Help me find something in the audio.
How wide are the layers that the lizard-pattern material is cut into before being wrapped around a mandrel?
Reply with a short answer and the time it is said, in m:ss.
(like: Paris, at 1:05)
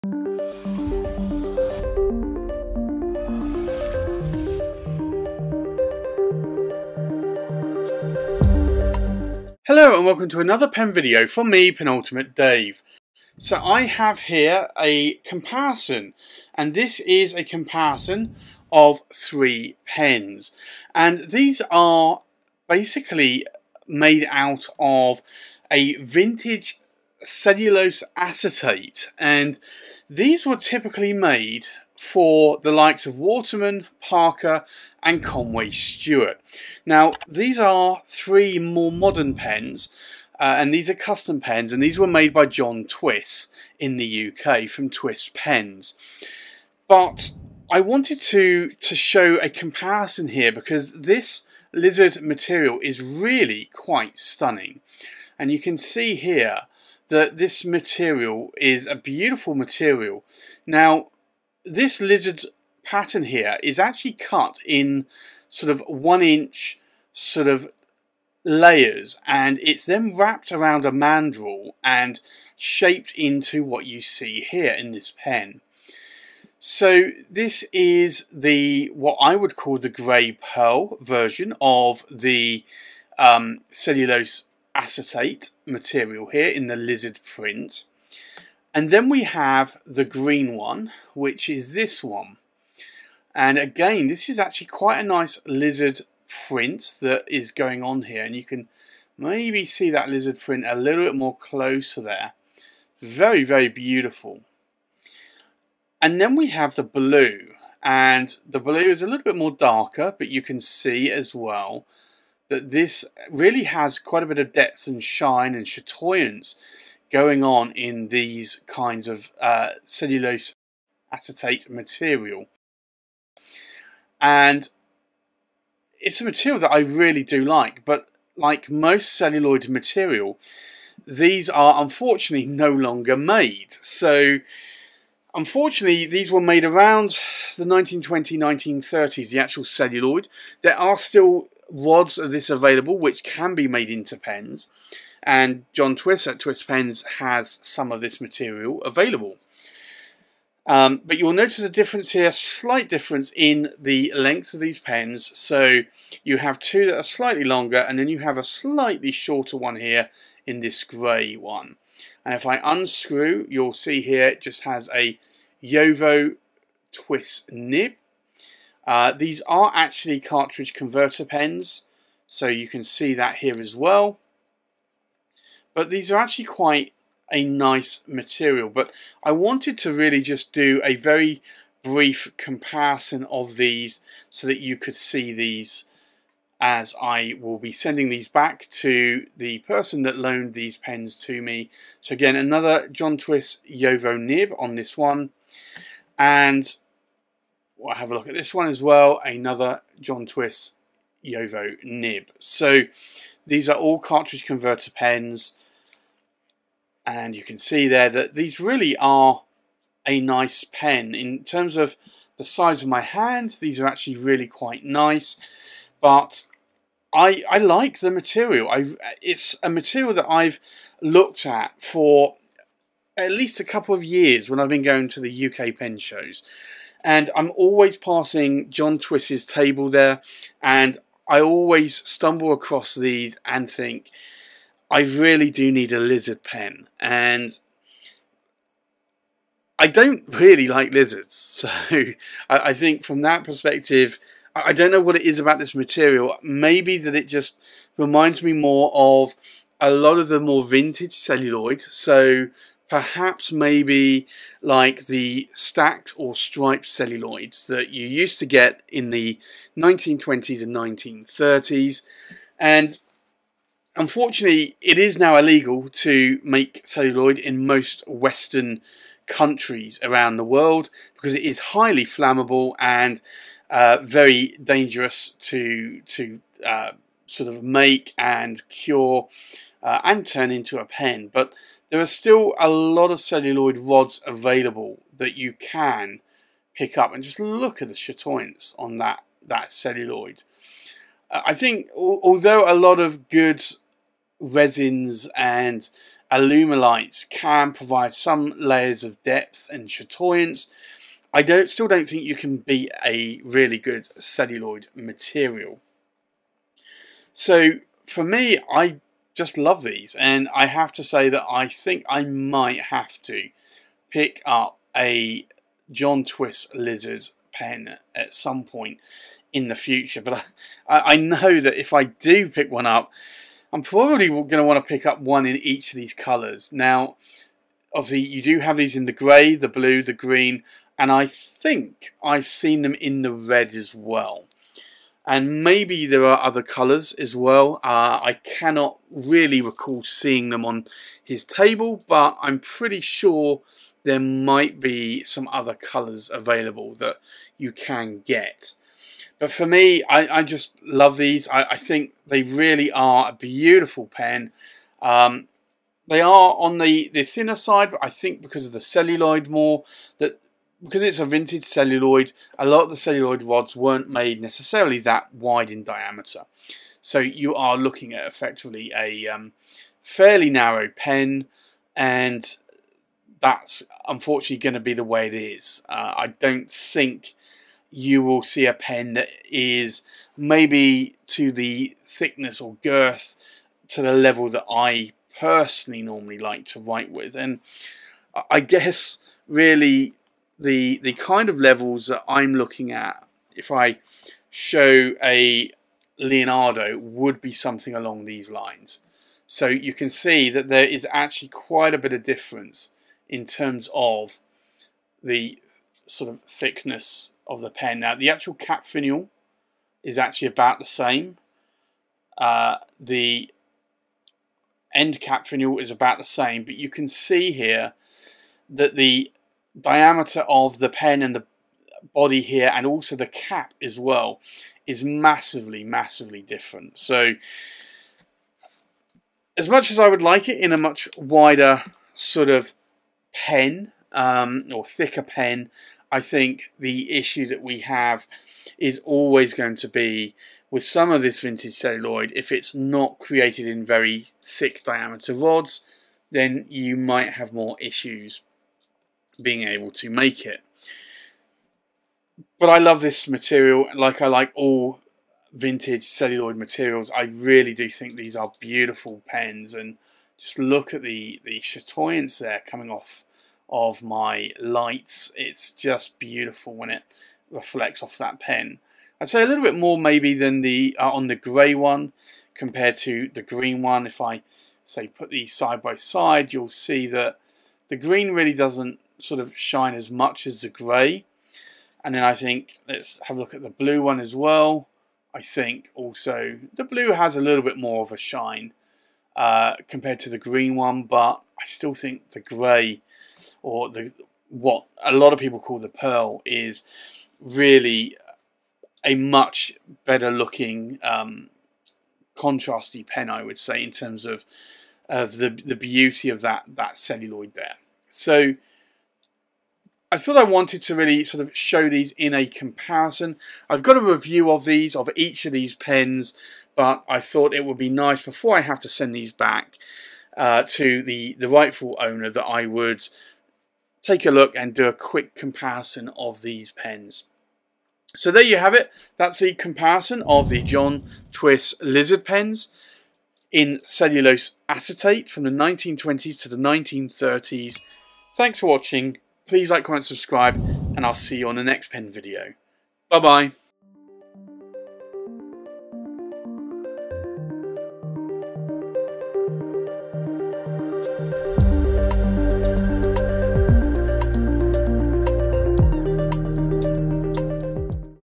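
1 inch, at 1:05.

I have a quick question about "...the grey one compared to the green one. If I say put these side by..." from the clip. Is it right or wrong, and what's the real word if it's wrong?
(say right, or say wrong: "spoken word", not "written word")
right.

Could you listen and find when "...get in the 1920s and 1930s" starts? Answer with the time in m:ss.
4:18.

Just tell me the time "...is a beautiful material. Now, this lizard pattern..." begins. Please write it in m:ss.
0:58.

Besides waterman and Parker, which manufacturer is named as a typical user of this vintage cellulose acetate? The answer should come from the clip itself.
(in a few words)
Conway Stewart.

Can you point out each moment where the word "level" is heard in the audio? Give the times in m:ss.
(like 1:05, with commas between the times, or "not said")
6:24, 6:31.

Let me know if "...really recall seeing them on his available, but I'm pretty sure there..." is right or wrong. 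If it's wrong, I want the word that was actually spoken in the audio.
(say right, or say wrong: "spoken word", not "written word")
wrong: "table", not "available".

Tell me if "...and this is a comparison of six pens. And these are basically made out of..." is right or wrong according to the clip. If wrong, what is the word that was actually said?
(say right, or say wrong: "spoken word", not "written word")
wrong: "three", not "six".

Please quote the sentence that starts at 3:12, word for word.
So again, another John Twiss Jowo nib on this one.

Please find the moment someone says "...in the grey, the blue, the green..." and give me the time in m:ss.
5:28.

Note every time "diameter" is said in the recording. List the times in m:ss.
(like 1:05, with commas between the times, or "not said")
6:05, 6:59, 7:24.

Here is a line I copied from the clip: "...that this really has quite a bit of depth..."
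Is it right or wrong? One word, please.
right.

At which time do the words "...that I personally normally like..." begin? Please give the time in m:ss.
6:24.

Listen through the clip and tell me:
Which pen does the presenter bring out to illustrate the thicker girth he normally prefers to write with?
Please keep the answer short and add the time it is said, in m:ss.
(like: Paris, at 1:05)
Leonardo, at 6:36.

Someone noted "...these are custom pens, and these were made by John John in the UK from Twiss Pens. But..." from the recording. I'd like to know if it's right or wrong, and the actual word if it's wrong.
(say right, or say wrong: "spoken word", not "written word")
wrong: "Twiss", not "John".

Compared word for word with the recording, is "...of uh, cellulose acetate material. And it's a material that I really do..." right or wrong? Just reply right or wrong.
right.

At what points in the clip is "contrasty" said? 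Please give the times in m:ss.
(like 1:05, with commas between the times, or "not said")
8:22.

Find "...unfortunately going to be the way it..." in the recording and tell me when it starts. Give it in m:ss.
6:14.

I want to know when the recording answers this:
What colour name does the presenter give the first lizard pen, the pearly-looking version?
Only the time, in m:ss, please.
1:19.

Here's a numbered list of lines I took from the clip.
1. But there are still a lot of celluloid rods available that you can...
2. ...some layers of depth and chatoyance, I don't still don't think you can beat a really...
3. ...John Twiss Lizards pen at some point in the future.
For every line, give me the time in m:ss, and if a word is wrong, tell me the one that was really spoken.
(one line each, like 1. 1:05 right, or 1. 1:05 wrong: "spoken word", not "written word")
1. 4:41 right
2. 4:58 right
3. 5:15 right.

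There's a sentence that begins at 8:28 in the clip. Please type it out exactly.
So I thought I wanted to really sort of show these in a comparison.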